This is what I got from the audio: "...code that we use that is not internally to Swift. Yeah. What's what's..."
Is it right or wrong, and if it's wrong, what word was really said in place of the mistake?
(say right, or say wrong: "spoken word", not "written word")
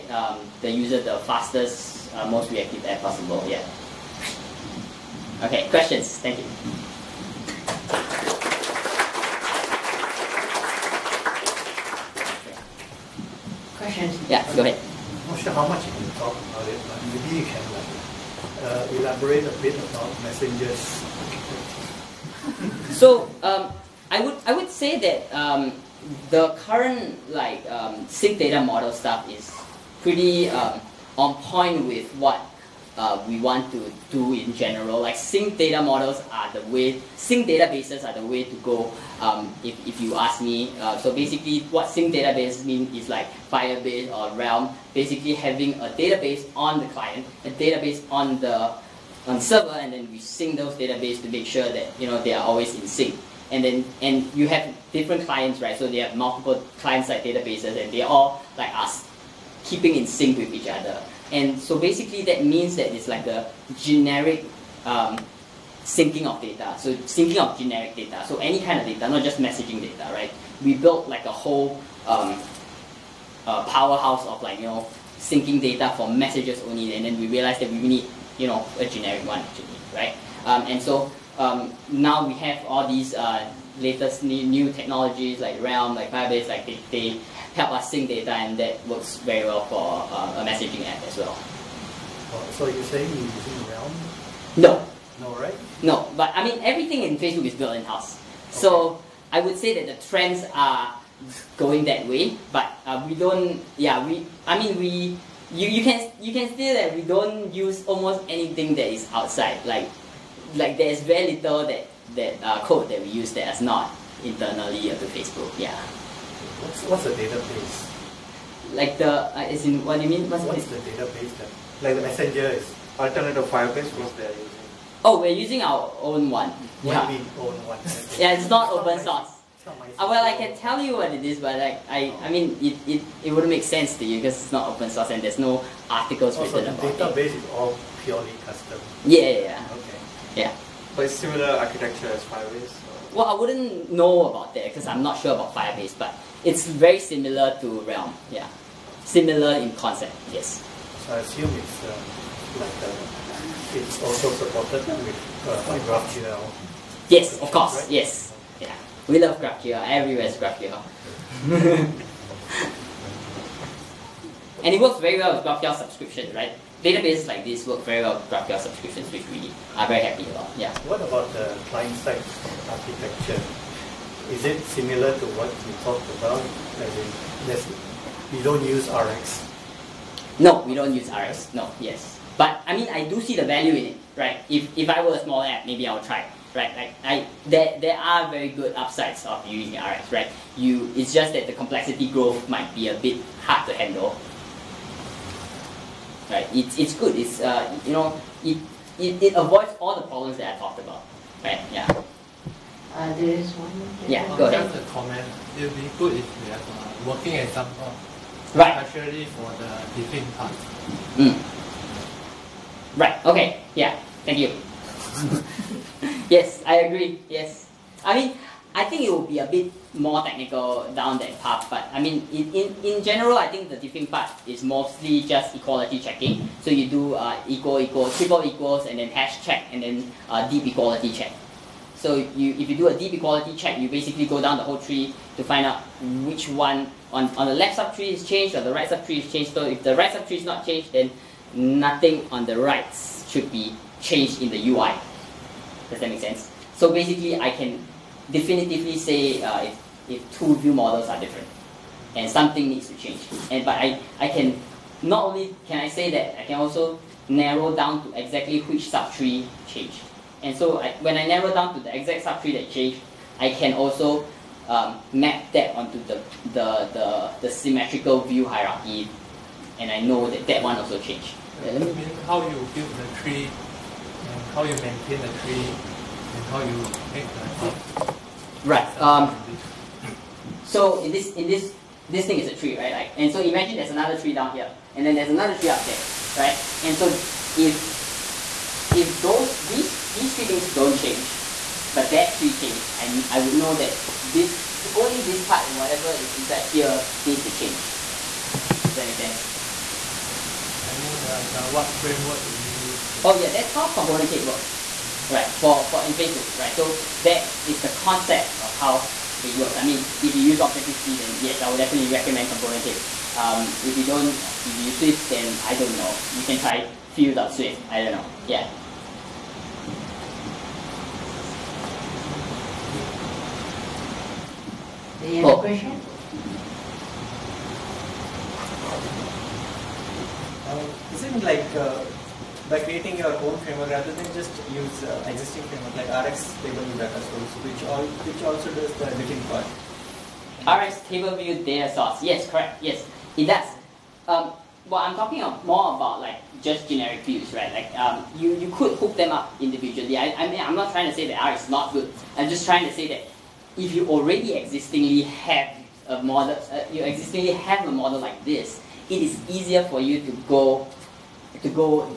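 wrong: "Facebook", not "Swift".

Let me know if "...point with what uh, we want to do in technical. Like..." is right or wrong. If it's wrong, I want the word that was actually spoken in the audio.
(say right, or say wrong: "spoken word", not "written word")
wrong: "general", not "technical".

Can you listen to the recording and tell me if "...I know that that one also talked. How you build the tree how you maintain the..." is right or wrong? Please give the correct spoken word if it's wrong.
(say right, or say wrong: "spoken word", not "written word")
wrong: "changed", not "talked".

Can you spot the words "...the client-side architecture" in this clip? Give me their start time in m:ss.
2:51.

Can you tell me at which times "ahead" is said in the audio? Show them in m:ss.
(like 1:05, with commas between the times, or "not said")
0:14, 3:24.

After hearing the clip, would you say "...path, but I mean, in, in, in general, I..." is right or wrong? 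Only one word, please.
right.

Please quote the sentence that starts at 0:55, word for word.
So they have multiple client-side databases, and they all like us, keeping in sync with each other.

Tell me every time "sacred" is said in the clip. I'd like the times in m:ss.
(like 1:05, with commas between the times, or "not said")
not said.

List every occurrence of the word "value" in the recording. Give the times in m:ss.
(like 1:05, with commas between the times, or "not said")
3:03.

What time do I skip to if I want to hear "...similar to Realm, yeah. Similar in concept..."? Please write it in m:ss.
2:26.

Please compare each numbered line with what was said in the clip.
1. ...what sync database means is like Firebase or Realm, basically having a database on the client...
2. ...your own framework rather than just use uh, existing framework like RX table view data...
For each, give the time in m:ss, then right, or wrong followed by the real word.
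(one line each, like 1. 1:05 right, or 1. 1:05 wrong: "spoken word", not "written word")
1. 0:41 right
2. 5:33 right.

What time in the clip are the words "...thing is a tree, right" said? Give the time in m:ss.
4:42.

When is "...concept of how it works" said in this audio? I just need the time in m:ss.
5:07.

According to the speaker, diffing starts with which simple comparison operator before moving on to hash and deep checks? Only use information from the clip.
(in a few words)
Triple equals.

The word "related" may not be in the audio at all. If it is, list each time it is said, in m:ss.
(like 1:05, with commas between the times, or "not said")
not said.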